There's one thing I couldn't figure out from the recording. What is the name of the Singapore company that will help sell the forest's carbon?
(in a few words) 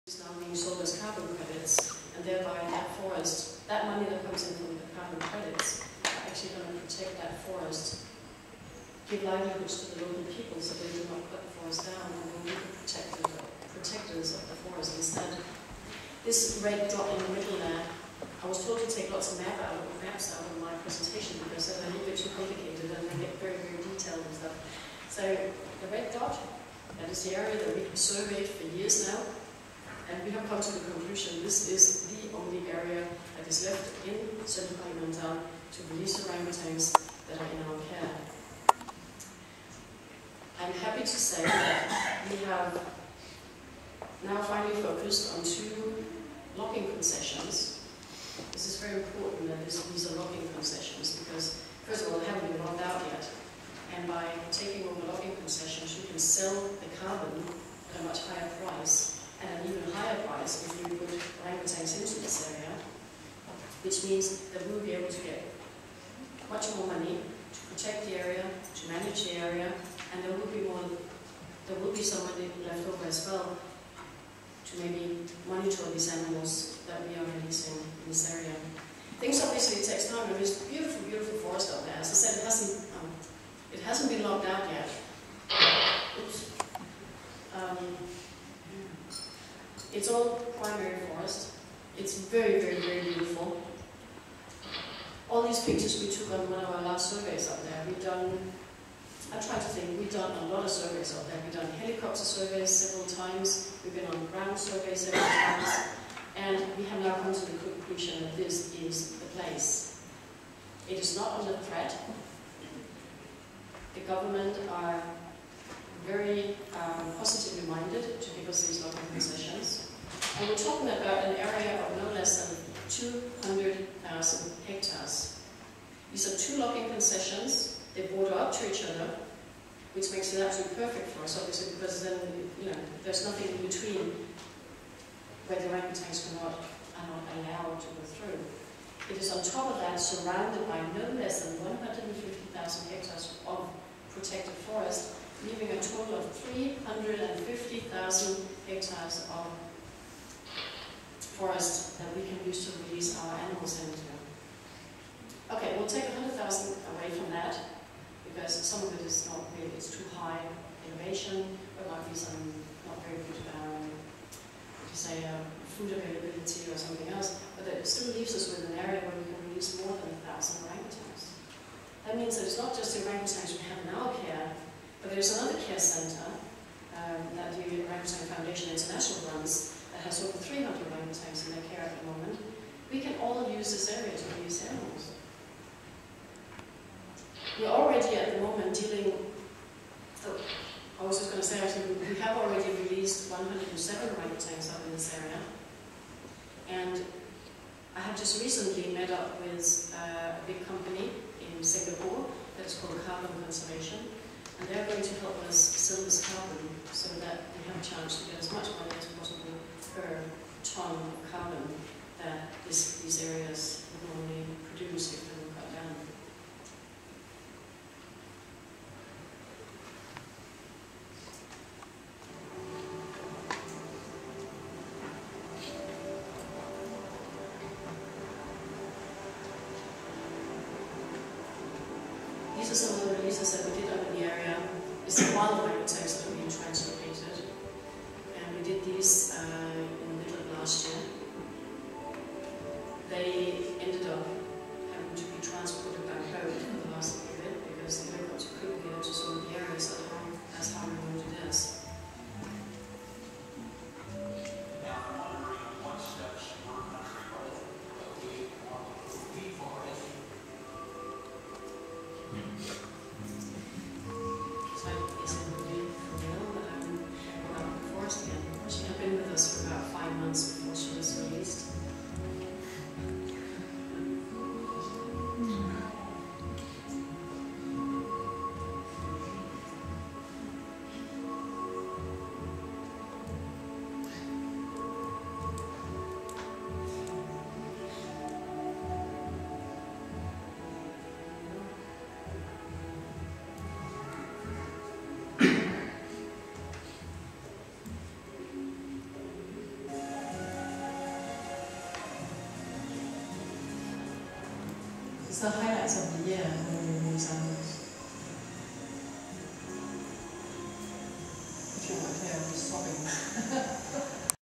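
Carbon Conservation.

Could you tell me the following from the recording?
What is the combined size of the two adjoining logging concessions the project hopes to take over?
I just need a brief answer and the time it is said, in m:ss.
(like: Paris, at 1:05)
200,000 hectares, at 2:02.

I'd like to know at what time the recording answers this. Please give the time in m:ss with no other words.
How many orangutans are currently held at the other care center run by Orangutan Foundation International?
3:00.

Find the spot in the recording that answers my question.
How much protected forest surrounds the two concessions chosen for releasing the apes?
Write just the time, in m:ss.
2:21.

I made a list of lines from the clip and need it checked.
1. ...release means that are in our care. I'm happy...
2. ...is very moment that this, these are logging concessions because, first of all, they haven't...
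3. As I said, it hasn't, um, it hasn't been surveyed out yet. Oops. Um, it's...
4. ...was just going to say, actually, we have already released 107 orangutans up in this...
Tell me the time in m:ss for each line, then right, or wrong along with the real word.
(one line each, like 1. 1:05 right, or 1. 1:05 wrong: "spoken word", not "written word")
1. 0:35 wrong: "orangutans", not "means"
2. 0:48 wrong: "important", not "moment"
3. 1:21 wrong: "logged", not "surveyed"
4. 3:11 right.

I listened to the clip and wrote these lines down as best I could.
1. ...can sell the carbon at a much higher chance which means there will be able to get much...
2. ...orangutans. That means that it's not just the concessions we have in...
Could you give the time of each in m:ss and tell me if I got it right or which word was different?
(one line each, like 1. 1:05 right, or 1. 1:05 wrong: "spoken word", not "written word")
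1. 0:56 wrong: "price", not "chance"
2. 2:50 wrong: "orangutans", not "concessions".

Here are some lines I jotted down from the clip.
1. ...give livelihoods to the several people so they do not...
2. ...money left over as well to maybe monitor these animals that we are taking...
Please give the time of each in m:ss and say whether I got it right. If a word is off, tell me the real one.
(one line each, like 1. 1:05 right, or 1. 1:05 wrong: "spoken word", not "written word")
1. 0:09 wrong: "local", not "several"
2. 1:12 wrong: "releasing", not "taking".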